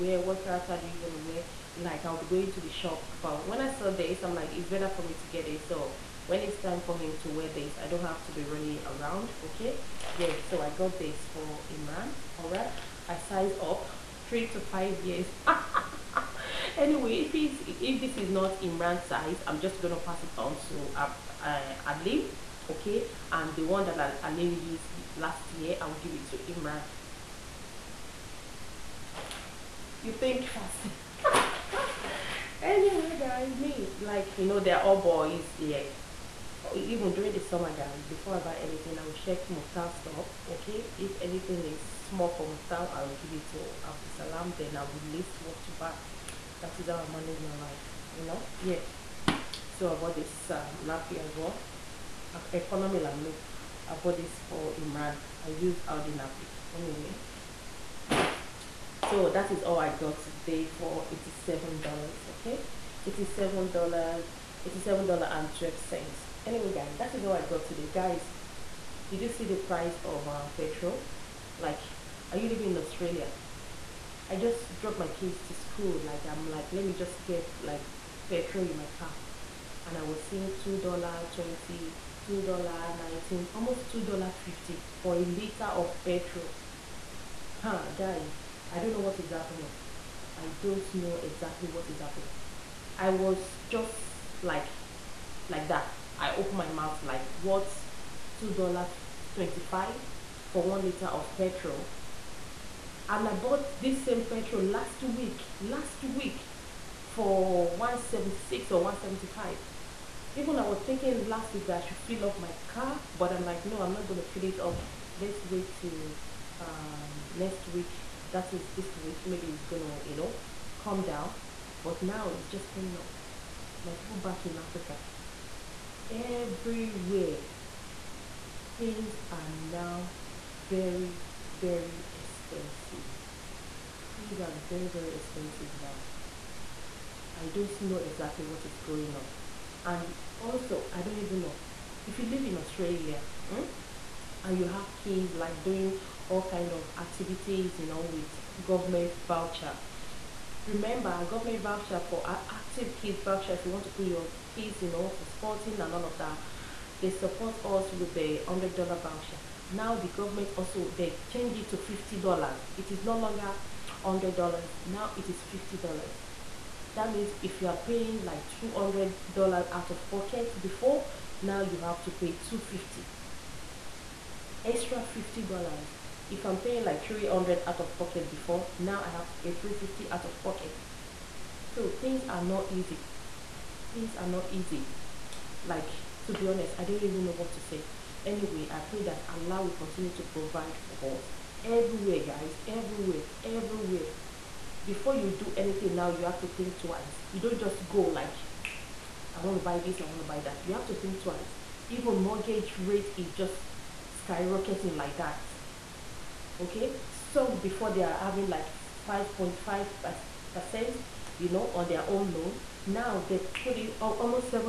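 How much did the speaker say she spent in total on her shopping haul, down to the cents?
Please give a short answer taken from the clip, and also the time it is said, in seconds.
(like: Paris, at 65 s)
$87.12, at 64 s.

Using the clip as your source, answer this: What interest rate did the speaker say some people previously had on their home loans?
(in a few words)
5.5%.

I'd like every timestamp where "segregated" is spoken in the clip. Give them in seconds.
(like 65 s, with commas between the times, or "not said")
not said.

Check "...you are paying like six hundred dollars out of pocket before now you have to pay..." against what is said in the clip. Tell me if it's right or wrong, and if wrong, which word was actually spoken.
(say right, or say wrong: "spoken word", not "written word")
wrong: "two", not "six".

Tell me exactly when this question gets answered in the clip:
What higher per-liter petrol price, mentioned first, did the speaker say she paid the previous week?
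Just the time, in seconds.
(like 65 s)
107 s.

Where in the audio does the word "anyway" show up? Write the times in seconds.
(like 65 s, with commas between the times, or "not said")
16 s, 32 s, 56 s, 66 s, 188 s.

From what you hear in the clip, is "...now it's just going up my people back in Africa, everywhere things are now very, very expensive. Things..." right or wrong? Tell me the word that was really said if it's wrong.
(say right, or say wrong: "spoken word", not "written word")
right.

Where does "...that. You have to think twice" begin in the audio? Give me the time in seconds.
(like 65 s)
200 s.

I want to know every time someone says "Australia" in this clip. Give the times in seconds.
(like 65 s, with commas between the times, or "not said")
72 s, 142 s.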